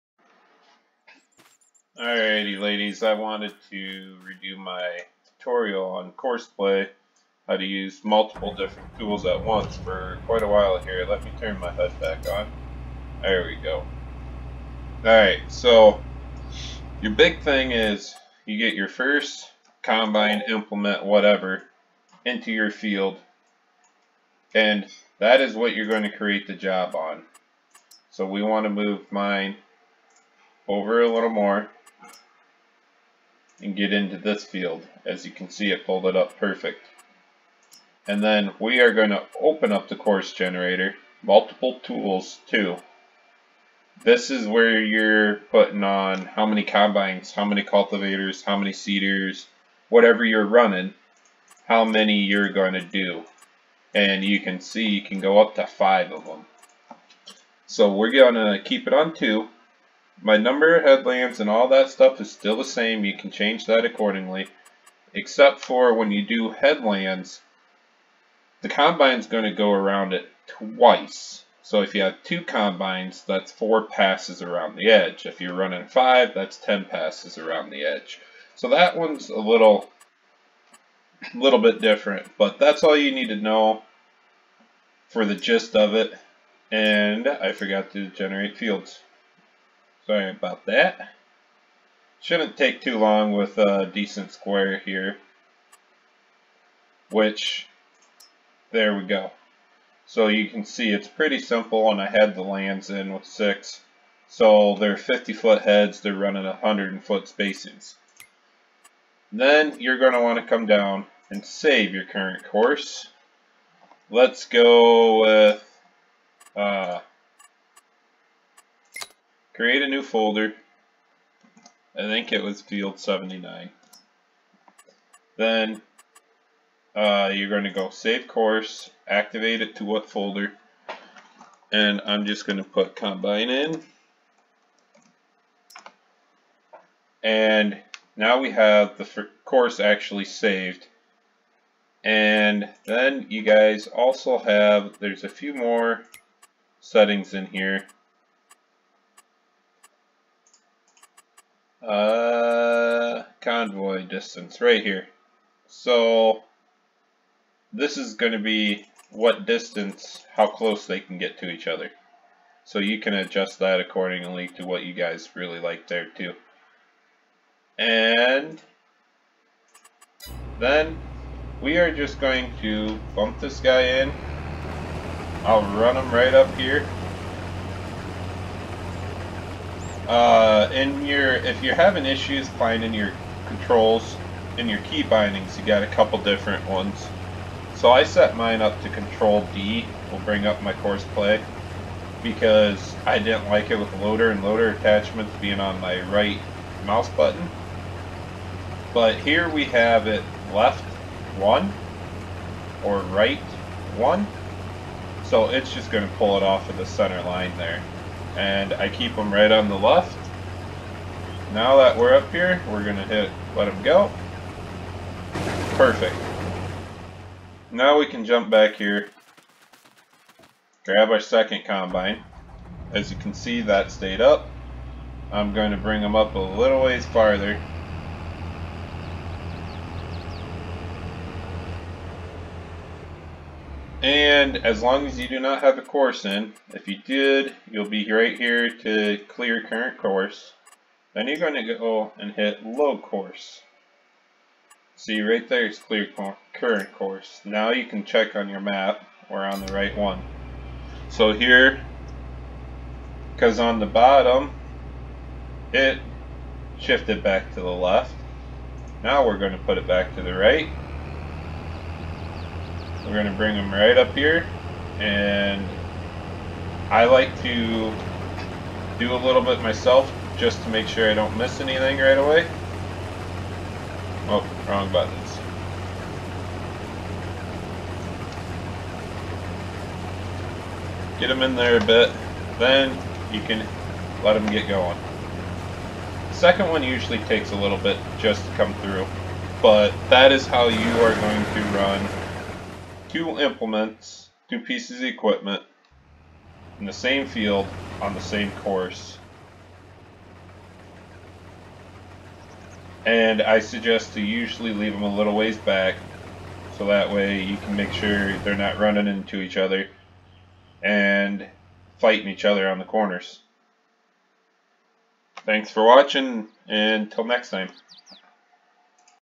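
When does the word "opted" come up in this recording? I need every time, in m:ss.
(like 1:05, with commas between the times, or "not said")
not said.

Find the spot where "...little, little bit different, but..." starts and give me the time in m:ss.
1:19.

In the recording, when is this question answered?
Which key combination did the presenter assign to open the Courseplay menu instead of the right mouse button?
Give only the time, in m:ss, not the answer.
3:08.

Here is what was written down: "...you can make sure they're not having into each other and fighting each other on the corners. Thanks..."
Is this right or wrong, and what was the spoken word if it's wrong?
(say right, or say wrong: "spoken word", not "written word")
wrong: "running", not "having".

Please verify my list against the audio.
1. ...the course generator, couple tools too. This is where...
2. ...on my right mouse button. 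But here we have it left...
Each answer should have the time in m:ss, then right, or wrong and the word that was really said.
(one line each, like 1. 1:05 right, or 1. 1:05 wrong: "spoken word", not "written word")
1. 0:39 wrong: "multiple", not "couple"
2. 3:15 right.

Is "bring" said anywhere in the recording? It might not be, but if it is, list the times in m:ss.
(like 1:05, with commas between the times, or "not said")
3:10, 3:45, 4:23.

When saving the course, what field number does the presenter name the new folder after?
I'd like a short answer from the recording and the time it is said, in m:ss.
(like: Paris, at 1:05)
79, at 2:02.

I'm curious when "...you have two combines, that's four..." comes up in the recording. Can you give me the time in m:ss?
1:11.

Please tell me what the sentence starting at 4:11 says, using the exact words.
So here, because on the bottom, it shifted back to the left.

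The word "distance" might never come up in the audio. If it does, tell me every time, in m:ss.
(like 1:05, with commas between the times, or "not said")
2:34, 2:39.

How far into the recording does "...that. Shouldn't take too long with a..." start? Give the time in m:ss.
1:30.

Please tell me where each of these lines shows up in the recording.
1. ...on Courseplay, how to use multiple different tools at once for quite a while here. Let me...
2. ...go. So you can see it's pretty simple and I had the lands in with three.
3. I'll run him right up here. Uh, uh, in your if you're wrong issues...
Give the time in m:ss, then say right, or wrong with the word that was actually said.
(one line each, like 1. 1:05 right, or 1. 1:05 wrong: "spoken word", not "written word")
1. 0:05 right
2. 1:39 wrong: "six", not "three"
3. 2:55 wrong: "having", not "wrong".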